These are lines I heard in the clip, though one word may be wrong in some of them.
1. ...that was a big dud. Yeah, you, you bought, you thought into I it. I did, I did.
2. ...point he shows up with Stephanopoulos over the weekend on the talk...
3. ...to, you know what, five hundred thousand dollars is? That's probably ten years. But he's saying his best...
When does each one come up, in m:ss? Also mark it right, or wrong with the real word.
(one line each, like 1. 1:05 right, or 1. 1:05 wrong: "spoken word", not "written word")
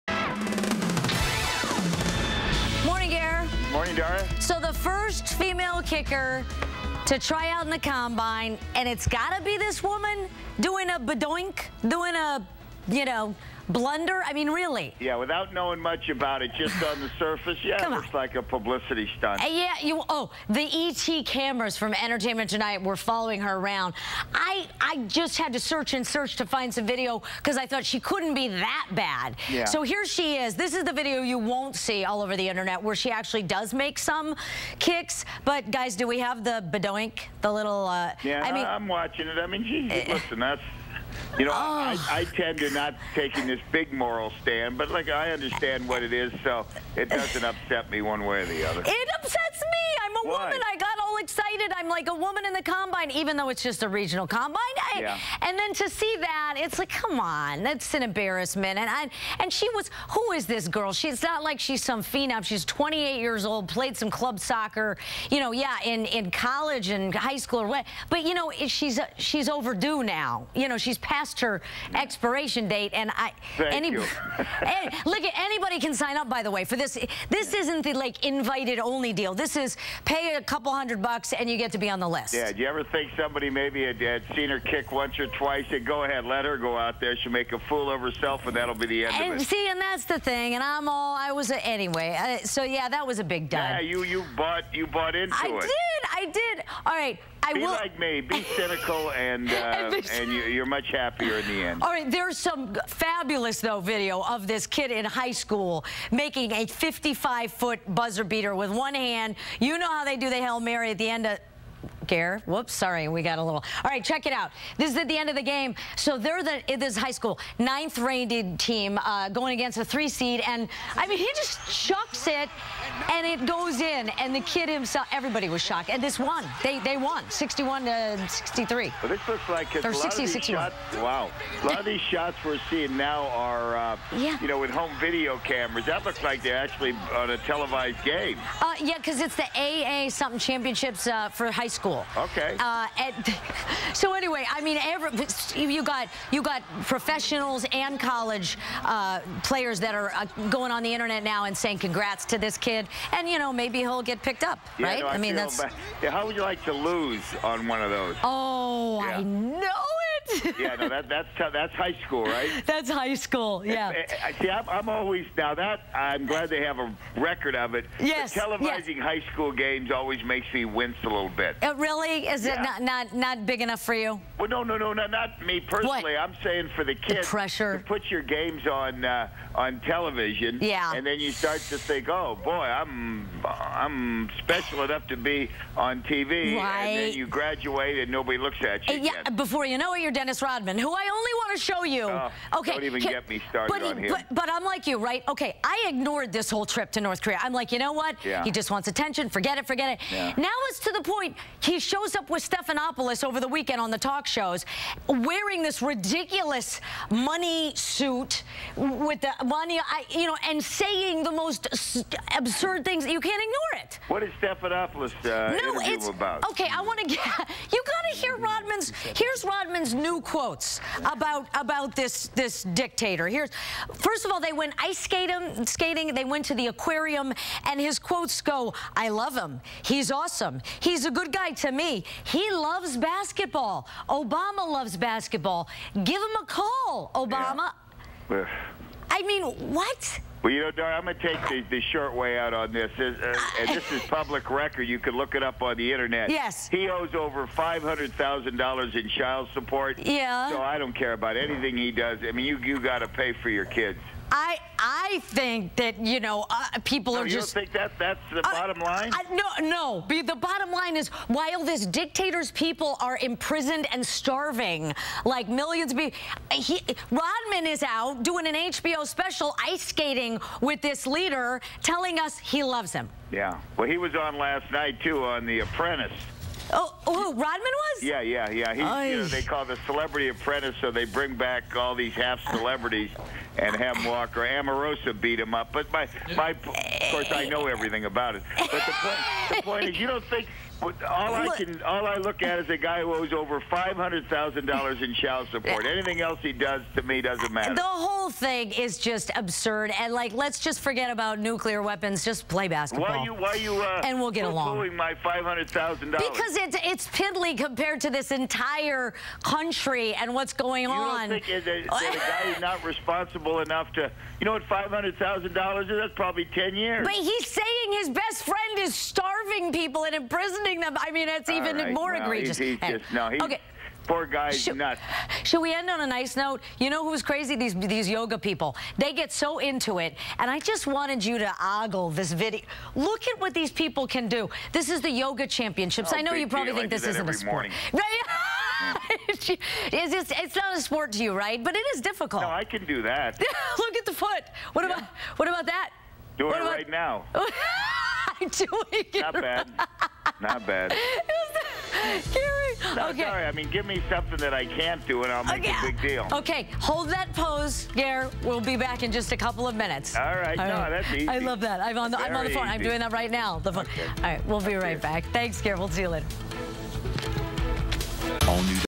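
1. 1:32 wrong: "bought", not "thought"
2. 3:21 right
3. 5:13 right.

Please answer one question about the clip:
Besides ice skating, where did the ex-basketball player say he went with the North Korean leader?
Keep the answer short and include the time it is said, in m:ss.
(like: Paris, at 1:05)
the aquarium, at 3:46.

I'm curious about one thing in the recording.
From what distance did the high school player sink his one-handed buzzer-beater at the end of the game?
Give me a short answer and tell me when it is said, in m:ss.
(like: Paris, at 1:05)
55 foot, at 1:46.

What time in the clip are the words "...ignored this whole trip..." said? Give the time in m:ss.
3:15.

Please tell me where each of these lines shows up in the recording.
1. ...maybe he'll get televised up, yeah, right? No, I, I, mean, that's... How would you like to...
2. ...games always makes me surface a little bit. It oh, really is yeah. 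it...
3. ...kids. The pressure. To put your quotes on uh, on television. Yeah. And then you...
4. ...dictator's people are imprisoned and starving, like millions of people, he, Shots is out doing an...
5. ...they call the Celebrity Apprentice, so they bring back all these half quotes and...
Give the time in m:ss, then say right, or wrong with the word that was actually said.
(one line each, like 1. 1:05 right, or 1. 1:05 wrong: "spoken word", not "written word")
1. 2:33 wrong: "picked", not "televised"
2. 2:49 wrong: "wince", not "surface"
3. 2:56 wrong: "games", not "quotes"
4. 4:21 wrong: "Rodman", not "Shots"
5. 4:39 wrong: "celebrities", not "quotes".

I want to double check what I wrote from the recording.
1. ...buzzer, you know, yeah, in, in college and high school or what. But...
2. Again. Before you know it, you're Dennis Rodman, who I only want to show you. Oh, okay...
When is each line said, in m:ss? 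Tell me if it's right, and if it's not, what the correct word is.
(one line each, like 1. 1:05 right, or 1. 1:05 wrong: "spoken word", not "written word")
1. 1:04 wrong: "soccer", not "buzzer"
2. 3:09 right.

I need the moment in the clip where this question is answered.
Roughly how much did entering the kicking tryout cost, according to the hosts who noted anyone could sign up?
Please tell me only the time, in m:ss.
1:20.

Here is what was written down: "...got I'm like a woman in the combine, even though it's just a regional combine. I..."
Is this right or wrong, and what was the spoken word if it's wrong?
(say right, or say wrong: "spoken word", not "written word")
right.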